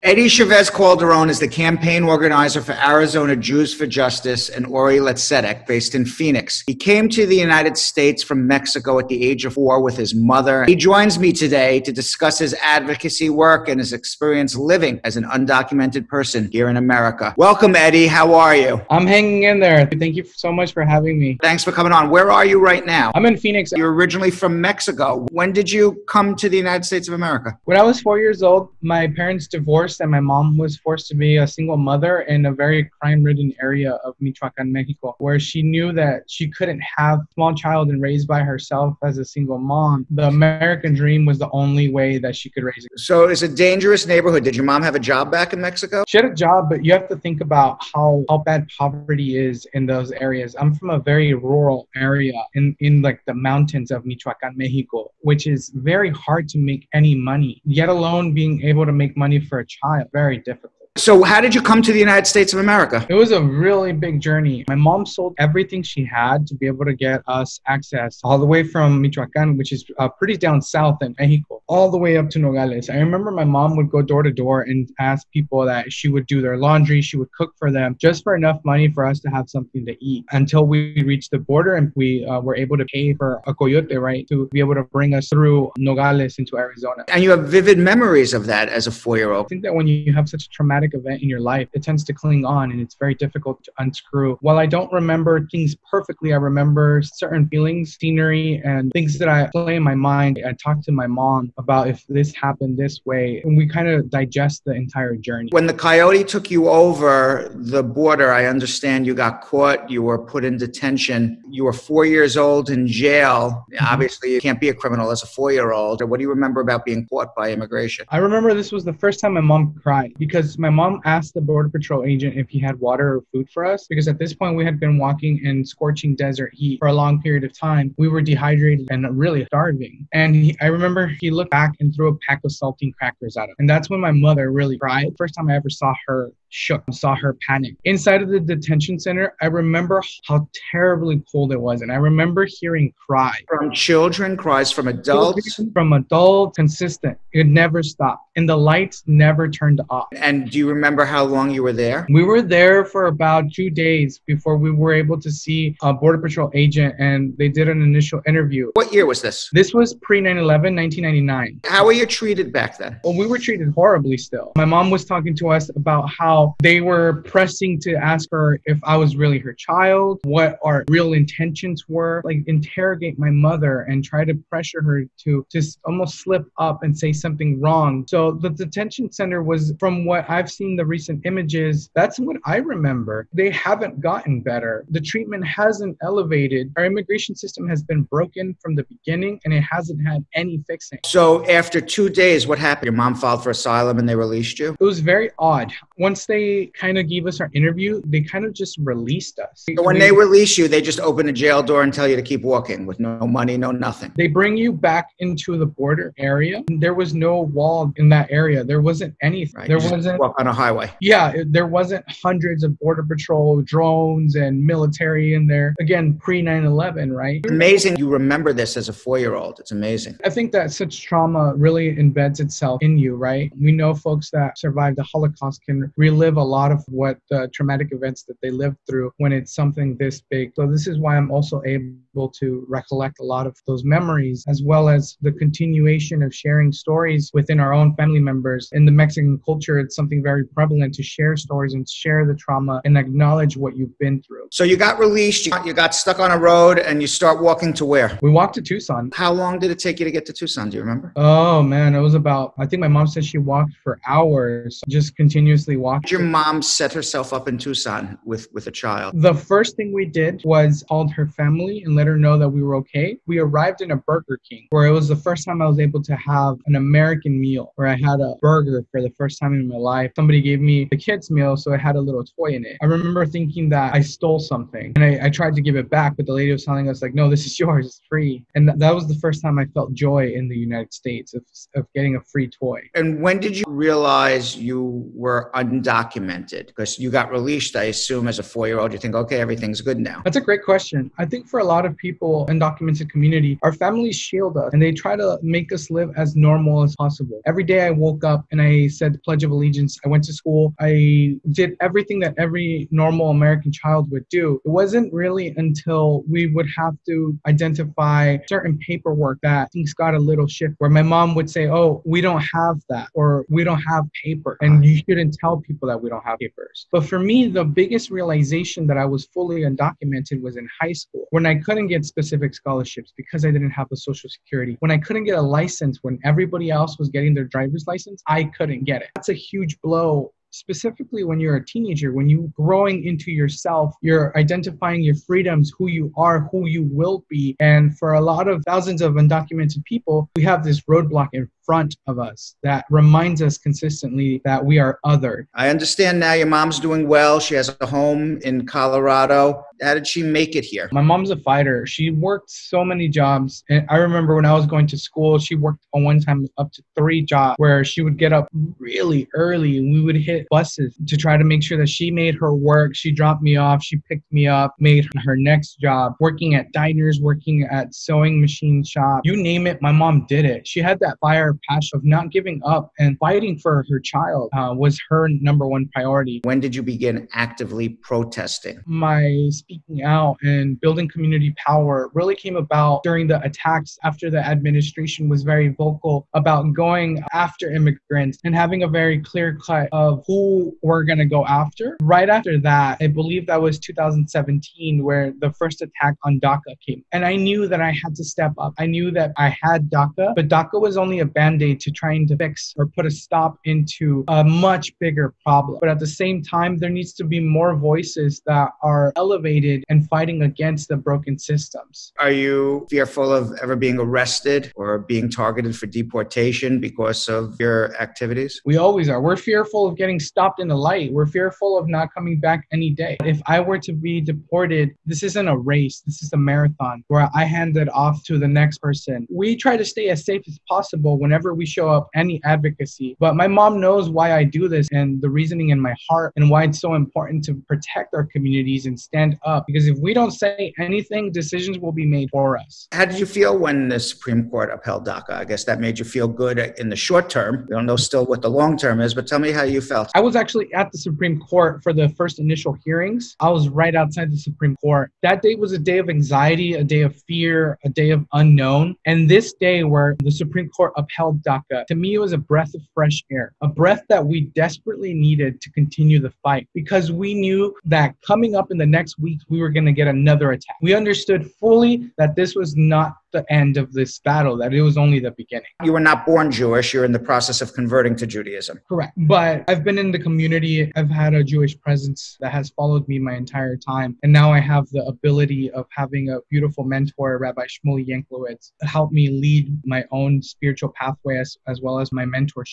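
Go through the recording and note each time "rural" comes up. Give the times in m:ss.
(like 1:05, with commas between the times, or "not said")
0:51.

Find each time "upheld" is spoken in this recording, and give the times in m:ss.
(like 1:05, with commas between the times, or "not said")
7:24, 7:40.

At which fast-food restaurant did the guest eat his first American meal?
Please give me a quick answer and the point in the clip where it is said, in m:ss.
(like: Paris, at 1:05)
Burger King, at 4:23.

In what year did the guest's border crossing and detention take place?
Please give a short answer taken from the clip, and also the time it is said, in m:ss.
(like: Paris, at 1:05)
1999, at 2:40.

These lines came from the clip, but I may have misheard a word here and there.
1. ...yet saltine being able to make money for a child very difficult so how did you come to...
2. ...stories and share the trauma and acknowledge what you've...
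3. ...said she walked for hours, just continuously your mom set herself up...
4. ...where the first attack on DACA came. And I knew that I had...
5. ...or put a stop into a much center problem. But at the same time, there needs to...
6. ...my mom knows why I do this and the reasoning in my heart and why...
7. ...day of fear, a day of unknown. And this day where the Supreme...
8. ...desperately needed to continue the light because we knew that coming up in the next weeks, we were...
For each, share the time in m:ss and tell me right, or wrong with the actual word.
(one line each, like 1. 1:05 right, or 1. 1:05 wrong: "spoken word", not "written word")
1. 0:57 wrong: "alone", not "saltine"
2. 4:01 right
3. 4:13 right
4. 6:35 right
5. 6:42 wrong: "bigger", not "center"
6. 7:13 right
7. 7:36 right
8. 7:44 wrong: "fight", not "light".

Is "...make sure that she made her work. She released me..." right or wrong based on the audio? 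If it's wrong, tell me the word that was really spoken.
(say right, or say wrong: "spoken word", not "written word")
wrong: "dropped", not "released".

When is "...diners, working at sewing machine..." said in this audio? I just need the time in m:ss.
6:06.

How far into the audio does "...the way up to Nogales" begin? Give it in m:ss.
1:11.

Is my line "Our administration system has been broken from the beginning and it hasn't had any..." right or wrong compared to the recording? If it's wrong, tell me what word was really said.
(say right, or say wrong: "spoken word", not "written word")
wrong: "immigration", not "administration".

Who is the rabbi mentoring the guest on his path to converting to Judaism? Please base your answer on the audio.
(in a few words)
Rabbi Shmuel Yanklowitz.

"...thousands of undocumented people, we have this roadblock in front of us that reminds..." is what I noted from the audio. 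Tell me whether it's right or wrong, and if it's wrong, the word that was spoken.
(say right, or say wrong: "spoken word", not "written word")
right.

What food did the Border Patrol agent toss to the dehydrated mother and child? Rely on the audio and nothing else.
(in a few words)
Saltine crackers.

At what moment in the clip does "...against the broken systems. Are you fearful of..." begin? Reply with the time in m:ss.
6:50.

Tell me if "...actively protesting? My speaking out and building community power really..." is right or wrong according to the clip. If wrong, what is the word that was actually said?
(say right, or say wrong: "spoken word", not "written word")
right.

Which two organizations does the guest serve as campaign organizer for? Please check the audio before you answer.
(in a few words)
Arizona Jews for Justice and Ori L'Tzedek.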